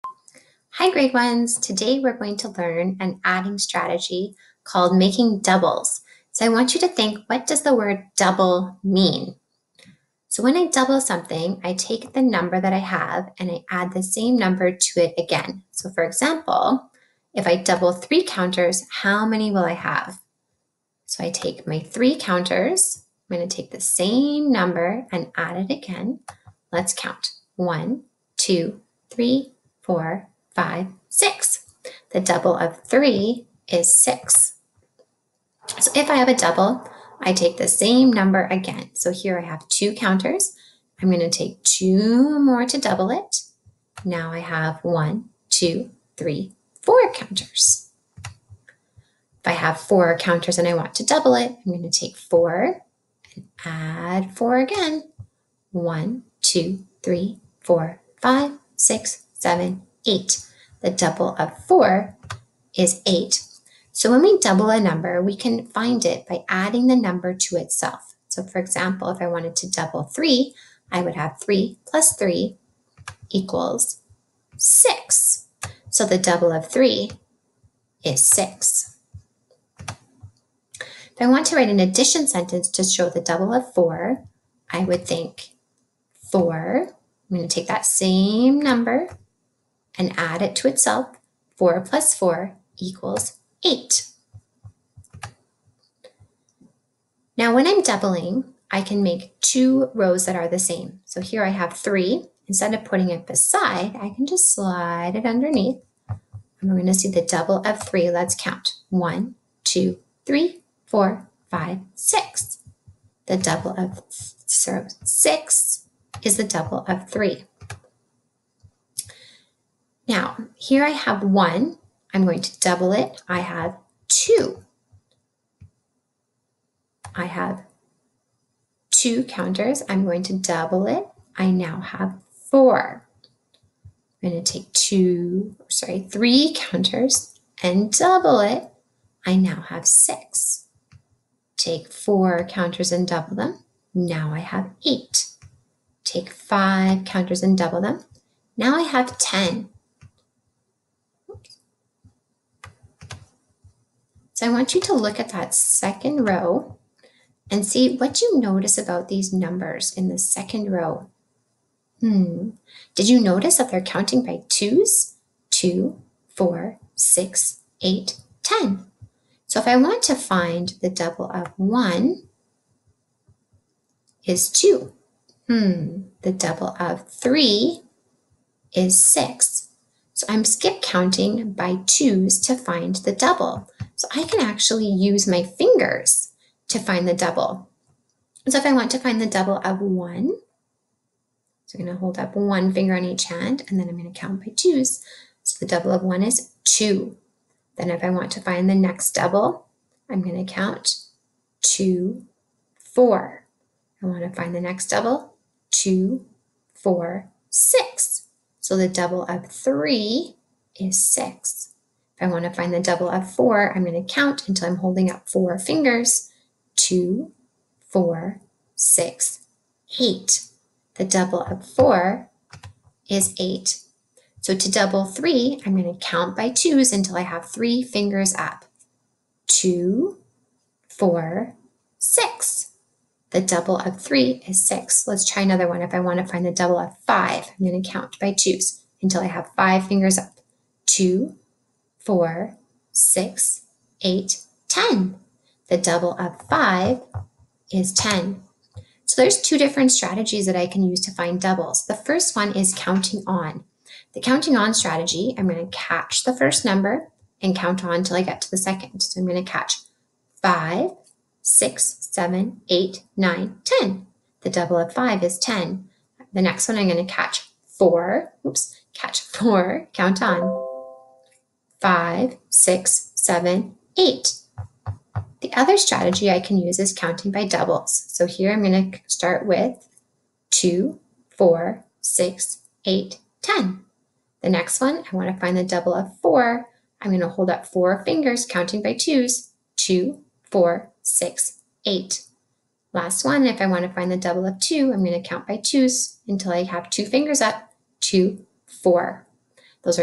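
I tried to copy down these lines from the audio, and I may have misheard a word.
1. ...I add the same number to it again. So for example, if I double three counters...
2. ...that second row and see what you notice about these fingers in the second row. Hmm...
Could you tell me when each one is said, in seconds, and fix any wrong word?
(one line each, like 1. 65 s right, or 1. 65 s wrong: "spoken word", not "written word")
1. 13 s right
2. 155 s wrong: "numbers", not "fingers".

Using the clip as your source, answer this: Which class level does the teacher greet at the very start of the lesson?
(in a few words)
grade ones.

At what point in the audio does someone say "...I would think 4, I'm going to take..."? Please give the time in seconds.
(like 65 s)
84 s.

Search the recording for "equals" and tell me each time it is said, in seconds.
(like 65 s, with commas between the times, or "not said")
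73 s, 92 s.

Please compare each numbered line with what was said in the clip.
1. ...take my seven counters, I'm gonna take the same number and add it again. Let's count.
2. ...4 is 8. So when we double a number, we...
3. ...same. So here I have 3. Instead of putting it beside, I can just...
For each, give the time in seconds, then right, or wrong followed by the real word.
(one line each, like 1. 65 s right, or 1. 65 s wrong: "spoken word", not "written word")
1. 21 s wrong: "three", not "seven"
2. 61 s right
3. 100 s right.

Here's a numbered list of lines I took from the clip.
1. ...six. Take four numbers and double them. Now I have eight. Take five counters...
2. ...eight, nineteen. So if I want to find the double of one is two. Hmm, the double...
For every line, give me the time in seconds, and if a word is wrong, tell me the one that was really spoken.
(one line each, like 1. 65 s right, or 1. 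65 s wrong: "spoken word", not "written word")
1. 139 s wrong: "counters", not "numbers"
2. 167 s wrong: "ten", not "nineteen".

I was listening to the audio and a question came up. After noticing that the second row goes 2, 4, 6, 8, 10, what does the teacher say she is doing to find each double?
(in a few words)
skip counting by twos.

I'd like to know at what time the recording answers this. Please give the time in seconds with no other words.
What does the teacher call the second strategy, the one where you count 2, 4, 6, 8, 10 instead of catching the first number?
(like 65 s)
276 s.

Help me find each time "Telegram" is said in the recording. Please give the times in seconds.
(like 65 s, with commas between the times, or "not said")
not said.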